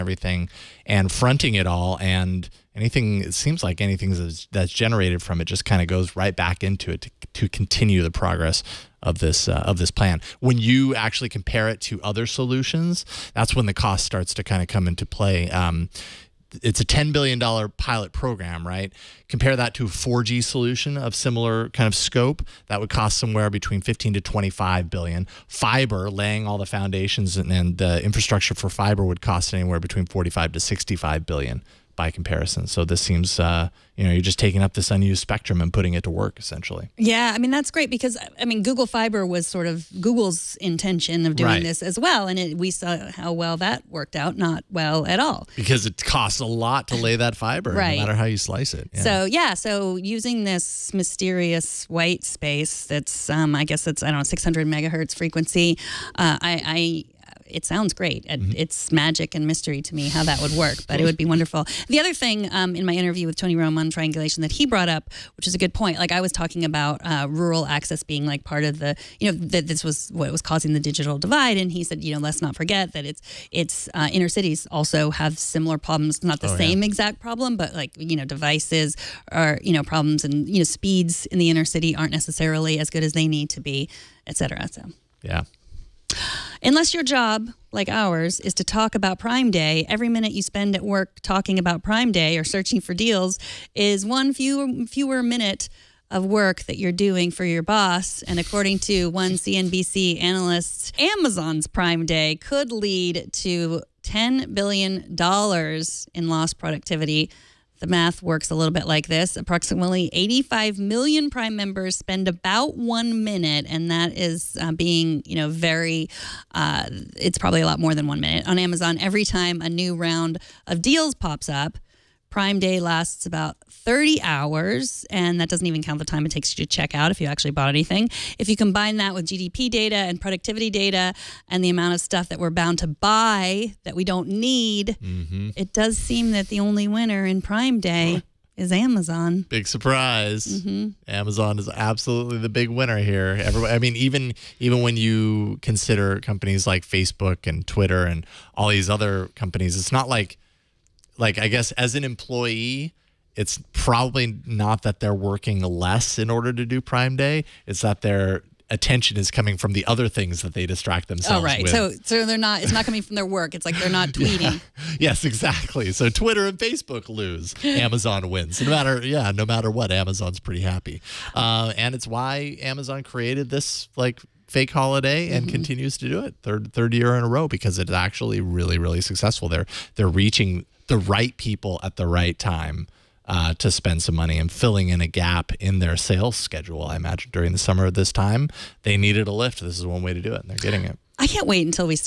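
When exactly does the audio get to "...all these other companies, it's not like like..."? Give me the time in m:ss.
2:28.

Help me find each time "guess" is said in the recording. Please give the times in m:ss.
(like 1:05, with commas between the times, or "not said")
0:53, 2:31.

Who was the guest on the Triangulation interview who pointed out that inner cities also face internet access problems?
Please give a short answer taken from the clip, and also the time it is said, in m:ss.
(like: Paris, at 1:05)
Tony Romm, at 1:03.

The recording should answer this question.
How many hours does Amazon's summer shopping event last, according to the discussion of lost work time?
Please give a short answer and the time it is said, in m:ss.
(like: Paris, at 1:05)
30 hours, at 2:03.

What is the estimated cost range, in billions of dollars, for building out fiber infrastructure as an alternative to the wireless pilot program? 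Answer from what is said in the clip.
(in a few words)
45 to 65 billion.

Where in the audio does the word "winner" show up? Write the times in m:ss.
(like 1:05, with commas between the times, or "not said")
2:16, 2:22.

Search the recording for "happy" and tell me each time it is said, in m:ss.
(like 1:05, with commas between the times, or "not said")
2:50.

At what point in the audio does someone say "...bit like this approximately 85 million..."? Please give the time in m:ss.
1:48.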